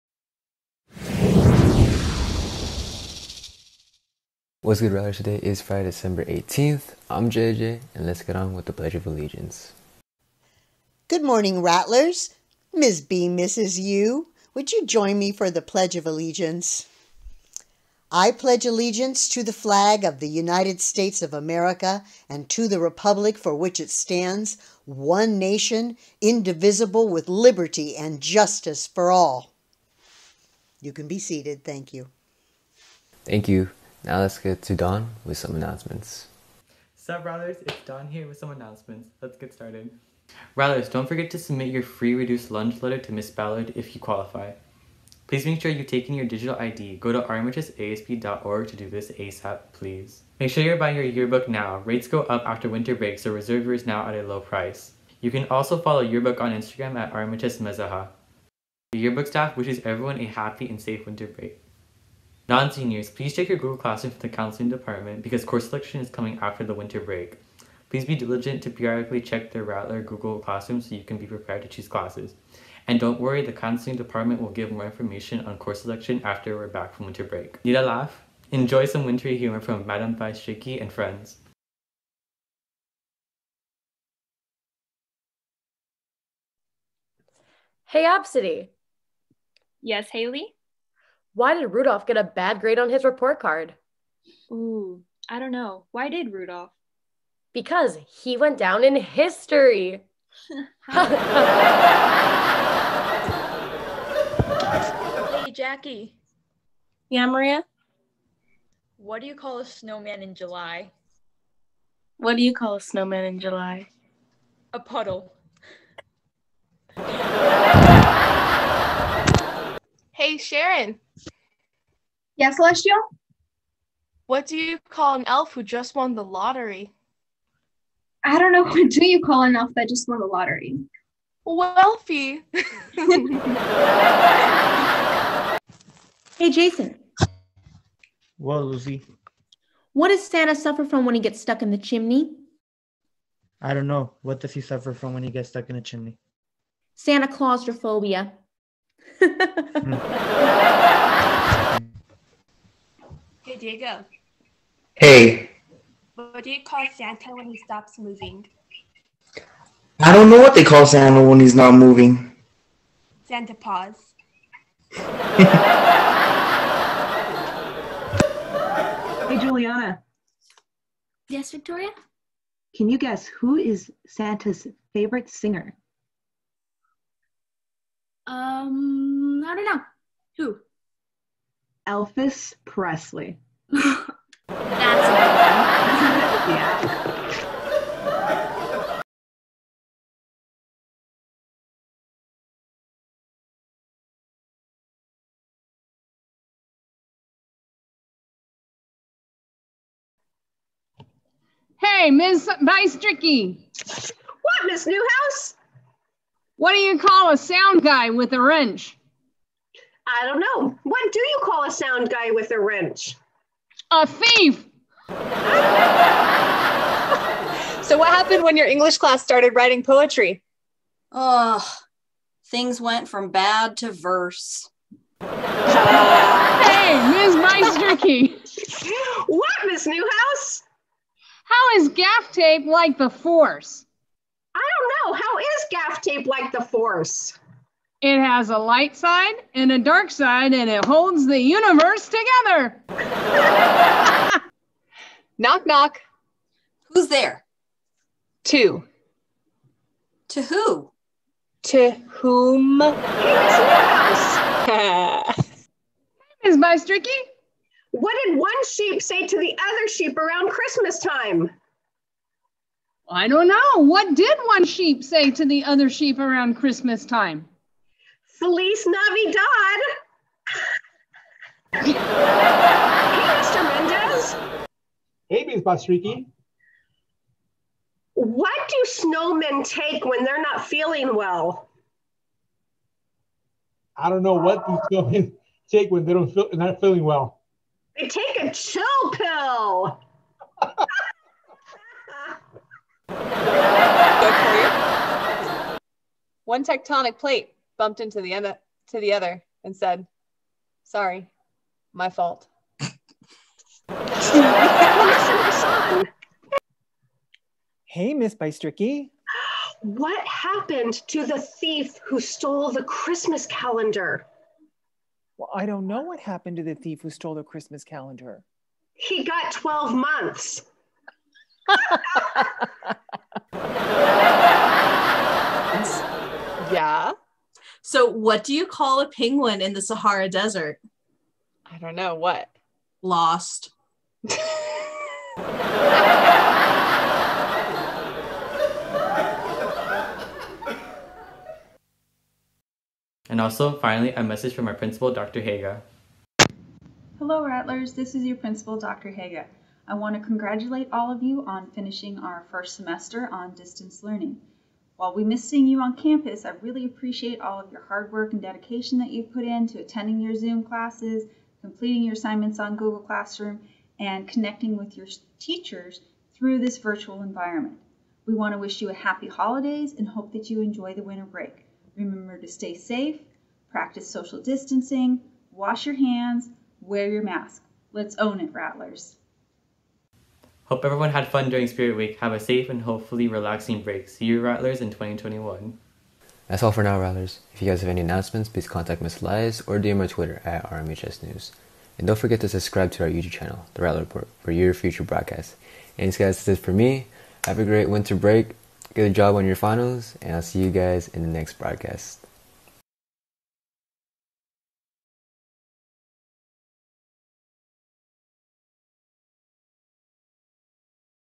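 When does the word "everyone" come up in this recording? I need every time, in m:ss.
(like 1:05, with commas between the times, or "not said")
0:59, 6:20.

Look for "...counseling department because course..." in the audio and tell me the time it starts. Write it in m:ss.
1:04.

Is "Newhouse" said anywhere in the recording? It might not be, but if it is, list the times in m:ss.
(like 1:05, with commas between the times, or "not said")
3:24, 3:49.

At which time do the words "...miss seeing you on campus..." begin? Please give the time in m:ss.
5:55.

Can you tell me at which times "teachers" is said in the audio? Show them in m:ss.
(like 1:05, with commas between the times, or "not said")
6:05.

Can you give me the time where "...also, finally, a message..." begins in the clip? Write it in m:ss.
5:43.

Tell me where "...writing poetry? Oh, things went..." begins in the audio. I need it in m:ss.
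3:39.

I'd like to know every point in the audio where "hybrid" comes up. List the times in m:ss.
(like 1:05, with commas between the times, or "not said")
not said.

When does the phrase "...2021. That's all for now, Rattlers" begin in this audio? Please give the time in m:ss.
6:24.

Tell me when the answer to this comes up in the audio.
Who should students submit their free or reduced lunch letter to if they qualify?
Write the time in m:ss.
0:43.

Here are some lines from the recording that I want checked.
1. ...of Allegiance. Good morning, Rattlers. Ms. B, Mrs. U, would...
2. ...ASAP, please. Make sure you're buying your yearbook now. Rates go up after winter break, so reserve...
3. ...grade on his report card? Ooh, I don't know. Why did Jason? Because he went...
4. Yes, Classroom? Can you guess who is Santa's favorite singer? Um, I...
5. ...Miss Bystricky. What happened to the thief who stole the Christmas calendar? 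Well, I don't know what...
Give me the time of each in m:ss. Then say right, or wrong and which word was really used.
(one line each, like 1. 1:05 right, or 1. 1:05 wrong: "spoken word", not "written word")
1. 0:08 right
2. 0:49 right
3. 1:32 wrong: "Rudolph", not "Jason"
4. 2:51 wrong: "Victoria", not "Classroom"
5. 5:08 right.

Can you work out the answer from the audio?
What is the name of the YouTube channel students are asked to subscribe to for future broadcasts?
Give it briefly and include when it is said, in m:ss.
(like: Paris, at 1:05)
The Rattler Report, at 6:33.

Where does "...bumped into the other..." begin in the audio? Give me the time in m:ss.
4:57.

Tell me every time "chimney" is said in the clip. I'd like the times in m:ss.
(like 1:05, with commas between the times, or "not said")
2:21, 2:25.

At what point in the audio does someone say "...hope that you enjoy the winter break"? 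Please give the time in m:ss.
6:10.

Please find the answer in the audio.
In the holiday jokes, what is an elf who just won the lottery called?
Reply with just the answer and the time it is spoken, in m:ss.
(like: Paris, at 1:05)
Wealthy, at 2:11.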